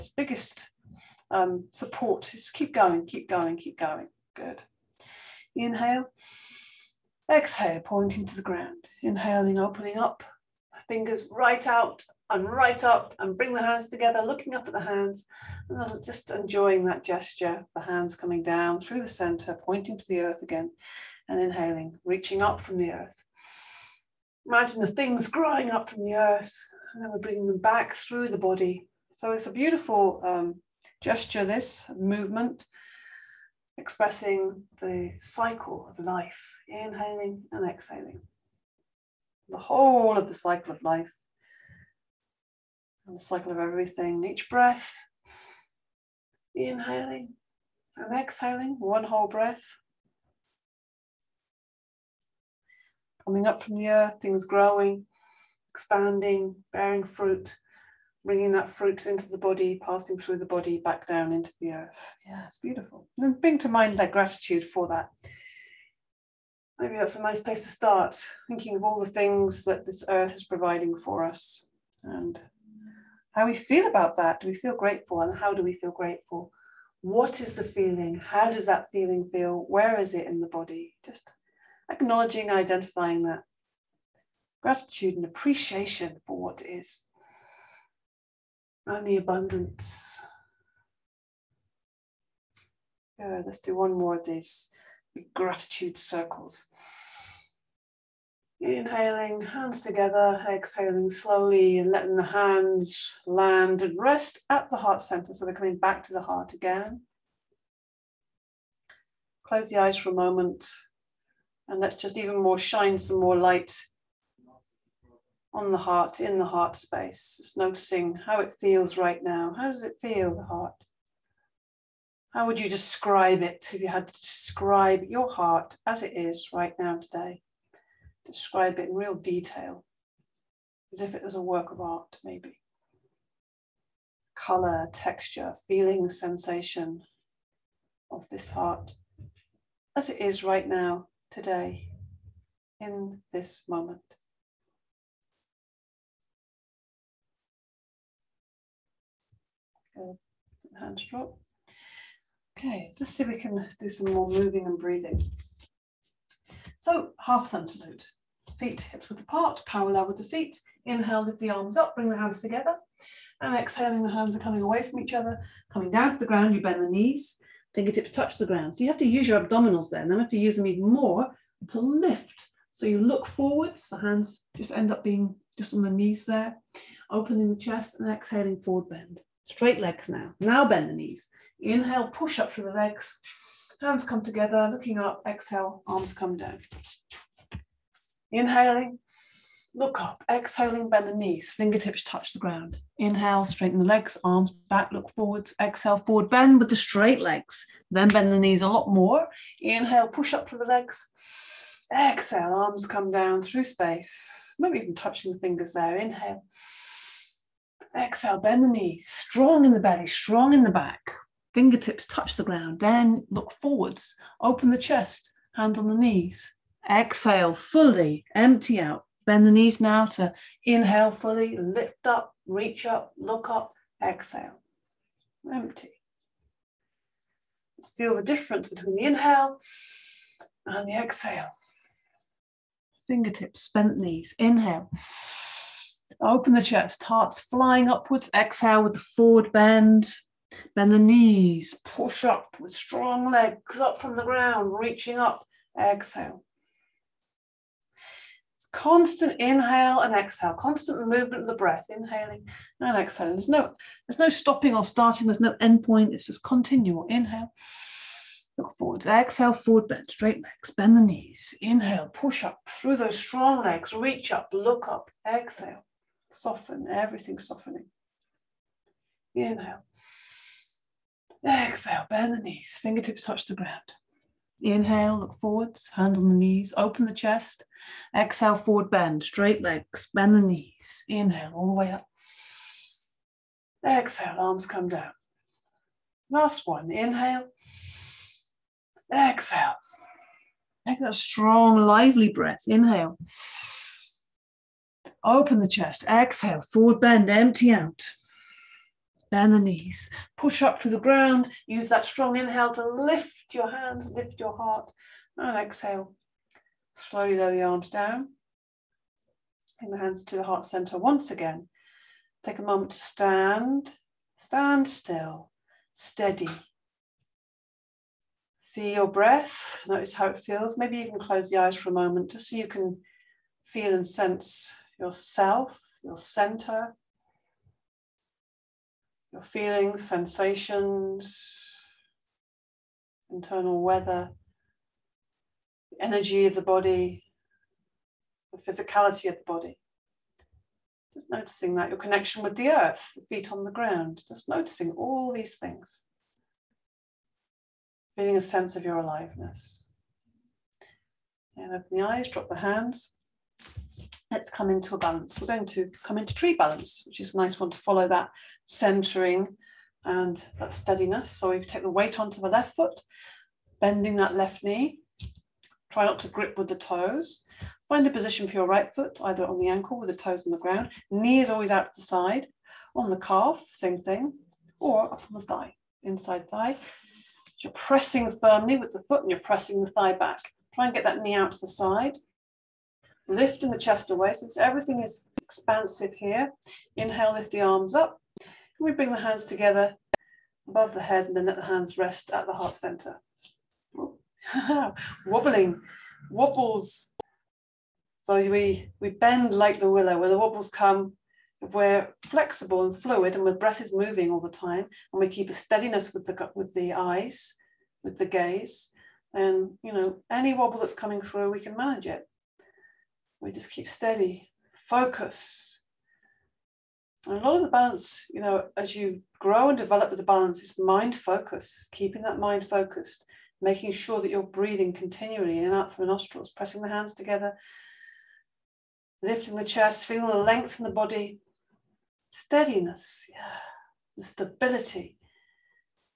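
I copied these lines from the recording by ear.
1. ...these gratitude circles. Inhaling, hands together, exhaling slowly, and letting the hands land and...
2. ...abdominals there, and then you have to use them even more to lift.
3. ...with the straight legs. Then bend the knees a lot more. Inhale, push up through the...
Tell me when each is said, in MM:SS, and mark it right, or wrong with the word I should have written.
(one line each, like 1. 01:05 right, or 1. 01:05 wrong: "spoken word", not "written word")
1. 01:34 right
2. 02:49 right
3. 03:16 right.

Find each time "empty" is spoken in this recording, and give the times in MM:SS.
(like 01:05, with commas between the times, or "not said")
03:38, 03:45, 04:57.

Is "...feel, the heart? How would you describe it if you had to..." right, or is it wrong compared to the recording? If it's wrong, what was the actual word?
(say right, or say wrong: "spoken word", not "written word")
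right.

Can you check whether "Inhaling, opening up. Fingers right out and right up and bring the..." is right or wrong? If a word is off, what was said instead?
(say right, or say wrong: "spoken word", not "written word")
right.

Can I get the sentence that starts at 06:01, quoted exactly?
So we take the weight onto the left foot, bending that left knee.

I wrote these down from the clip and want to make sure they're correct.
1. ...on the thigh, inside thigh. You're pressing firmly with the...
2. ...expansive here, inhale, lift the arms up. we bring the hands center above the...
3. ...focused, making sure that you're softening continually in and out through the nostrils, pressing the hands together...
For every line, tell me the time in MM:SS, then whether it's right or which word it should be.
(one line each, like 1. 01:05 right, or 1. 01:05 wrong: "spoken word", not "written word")
1. 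06:15 right
2. 06:25 wrong: "together", not "center"
3. 07:02 wrong: "breathing", not "softening".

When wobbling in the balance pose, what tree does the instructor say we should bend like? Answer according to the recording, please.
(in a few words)
The willow.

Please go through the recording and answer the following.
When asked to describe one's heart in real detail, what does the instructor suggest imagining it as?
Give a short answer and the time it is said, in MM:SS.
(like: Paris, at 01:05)
A work of art, at 02:10.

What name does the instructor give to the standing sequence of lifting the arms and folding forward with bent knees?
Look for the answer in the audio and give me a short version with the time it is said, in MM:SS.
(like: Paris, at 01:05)
Half sun salute, at 02:37.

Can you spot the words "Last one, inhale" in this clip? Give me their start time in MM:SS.
04:46.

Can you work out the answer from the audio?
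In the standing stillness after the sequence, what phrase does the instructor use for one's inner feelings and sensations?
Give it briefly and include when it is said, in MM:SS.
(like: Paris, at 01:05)
Internal weather, at 05:33.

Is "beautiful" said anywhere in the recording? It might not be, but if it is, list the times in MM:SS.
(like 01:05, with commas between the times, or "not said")
00:29, 01:02.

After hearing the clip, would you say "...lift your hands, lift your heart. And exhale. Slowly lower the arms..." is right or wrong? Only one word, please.
right.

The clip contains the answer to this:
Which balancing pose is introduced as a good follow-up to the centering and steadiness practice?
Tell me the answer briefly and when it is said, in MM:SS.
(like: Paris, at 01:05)
Tree balance, at 05:56.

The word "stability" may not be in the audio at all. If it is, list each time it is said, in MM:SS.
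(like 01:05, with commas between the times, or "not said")
07:14.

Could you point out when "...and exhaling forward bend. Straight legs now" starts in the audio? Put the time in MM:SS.
02:57.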